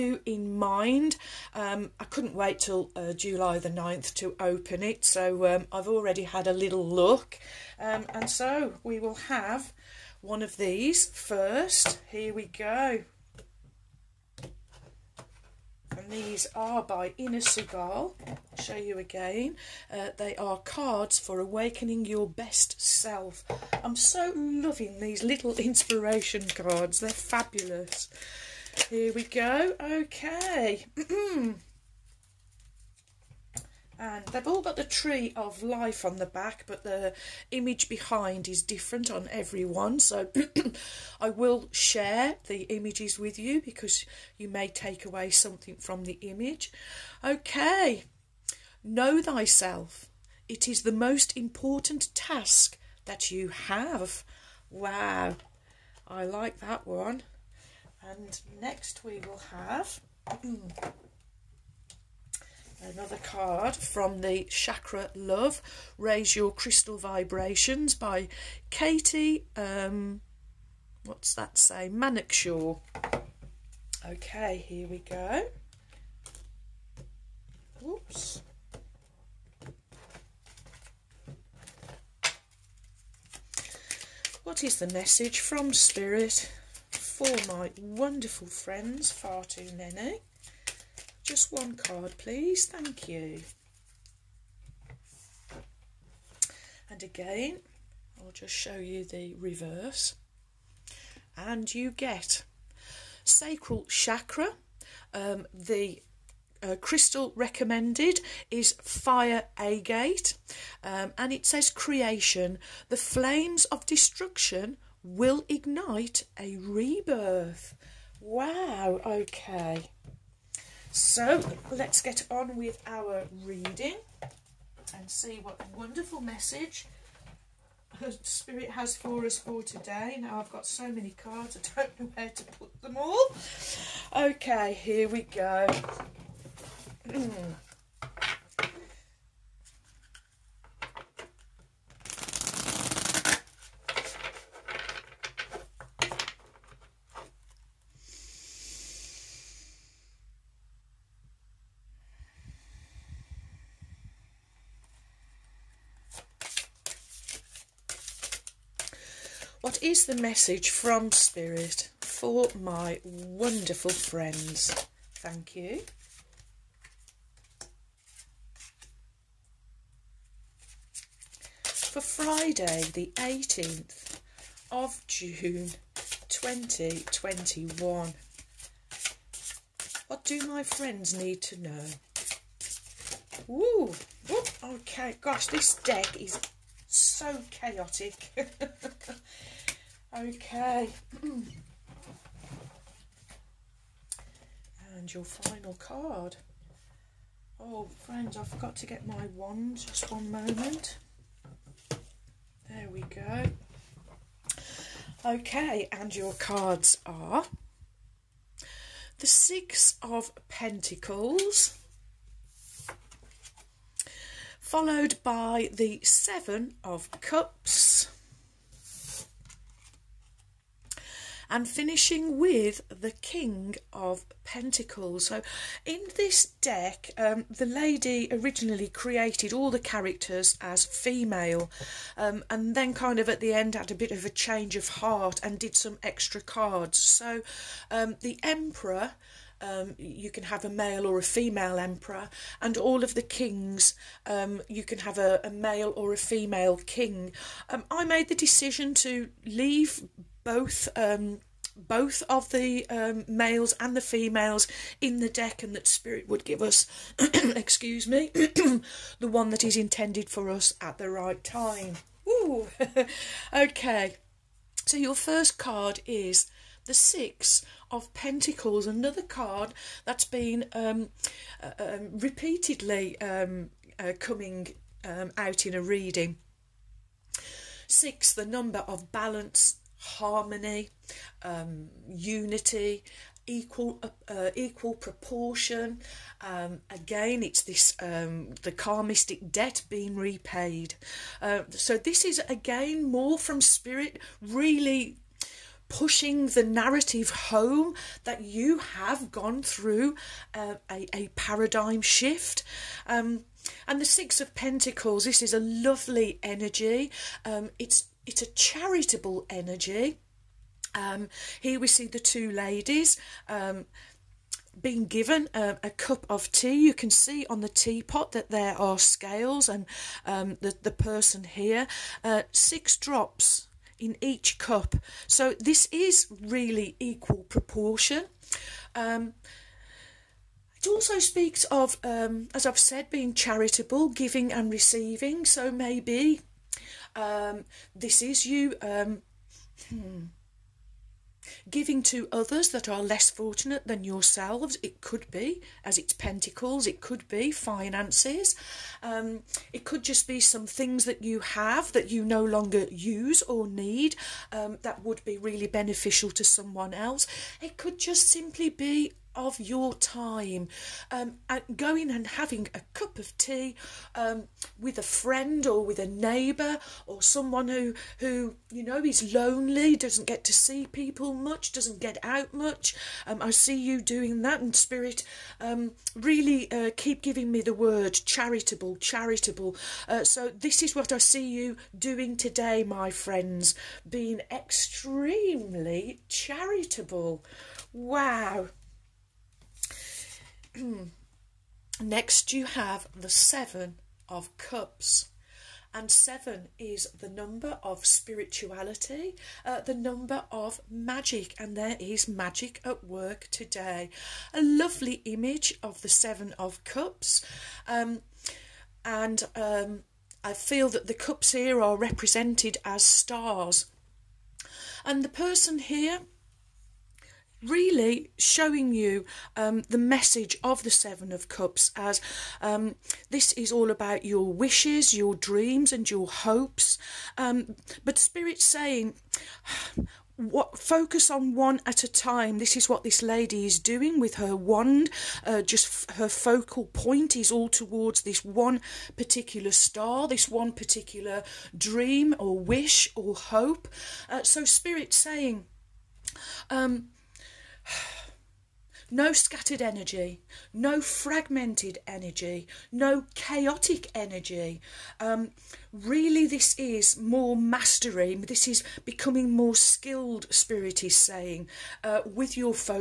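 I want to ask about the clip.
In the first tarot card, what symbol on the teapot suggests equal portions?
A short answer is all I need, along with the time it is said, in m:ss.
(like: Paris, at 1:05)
Scales, at 5:18.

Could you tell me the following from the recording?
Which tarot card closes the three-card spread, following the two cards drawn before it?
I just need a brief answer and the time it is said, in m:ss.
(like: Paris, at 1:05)
King of Pentacles, at 3:43.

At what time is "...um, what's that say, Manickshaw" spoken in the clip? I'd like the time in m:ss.
1:09.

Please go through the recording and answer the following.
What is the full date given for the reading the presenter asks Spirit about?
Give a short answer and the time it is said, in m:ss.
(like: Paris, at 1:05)
Friday 18 June 2021, at 2:51.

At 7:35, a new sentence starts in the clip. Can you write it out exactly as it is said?
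Um, really, this is more mastery.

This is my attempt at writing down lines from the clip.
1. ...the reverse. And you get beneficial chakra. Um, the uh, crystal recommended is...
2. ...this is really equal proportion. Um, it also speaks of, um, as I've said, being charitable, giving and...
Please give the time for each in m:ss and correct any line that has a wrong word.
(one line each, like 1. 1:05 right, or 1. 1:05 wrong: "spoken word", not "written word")
1. 1:39 wrong: "sacral", not "beneficial"
2. 5:25 right.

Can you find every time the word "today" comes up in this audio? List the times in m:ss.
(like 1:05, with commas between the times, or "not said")
2:09, 6:22, 6:43.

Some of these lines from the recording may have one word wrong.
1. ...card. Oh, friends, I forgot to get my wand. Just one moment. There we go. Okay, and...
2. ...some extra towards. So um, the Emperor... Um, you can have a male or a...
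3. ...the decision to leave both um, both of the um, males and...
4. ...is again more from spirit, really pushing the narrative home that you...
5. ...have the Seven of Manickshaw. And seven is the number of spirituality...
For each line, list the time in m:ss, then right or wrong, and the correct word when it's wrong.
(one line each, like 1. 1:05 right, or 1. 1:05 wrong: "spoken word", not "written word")
1. 3:15 right
2. 3:55 wrong: "cards", not "towards"
3. 4:08 right
4. 4:52 right
5. 6:32 wrong: "Cups", not "Manickshaw".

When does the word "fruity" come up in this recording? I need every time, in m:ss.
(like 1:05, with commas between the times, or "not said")
not said.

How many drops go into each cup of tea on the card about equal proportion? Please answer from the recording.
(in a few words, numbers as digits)
6.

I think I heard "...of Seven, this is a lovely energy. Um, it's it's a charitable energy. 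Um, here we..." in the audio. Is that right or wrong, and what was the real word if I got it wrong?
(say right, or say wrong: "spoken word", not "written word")
wrong: "Pentacles", not "Seven".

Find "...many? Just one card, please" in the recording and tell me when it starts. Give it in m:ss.
1:29.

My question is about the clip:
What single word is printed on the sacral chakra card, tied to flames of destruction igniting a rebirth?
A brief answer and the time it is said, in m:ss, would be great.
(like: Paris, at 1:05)
Creation, at 1:51.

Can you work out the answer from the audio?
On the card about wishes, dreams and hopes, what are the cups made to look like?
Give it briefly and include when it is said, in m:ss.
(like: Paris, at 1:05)
Stars, at 6:53.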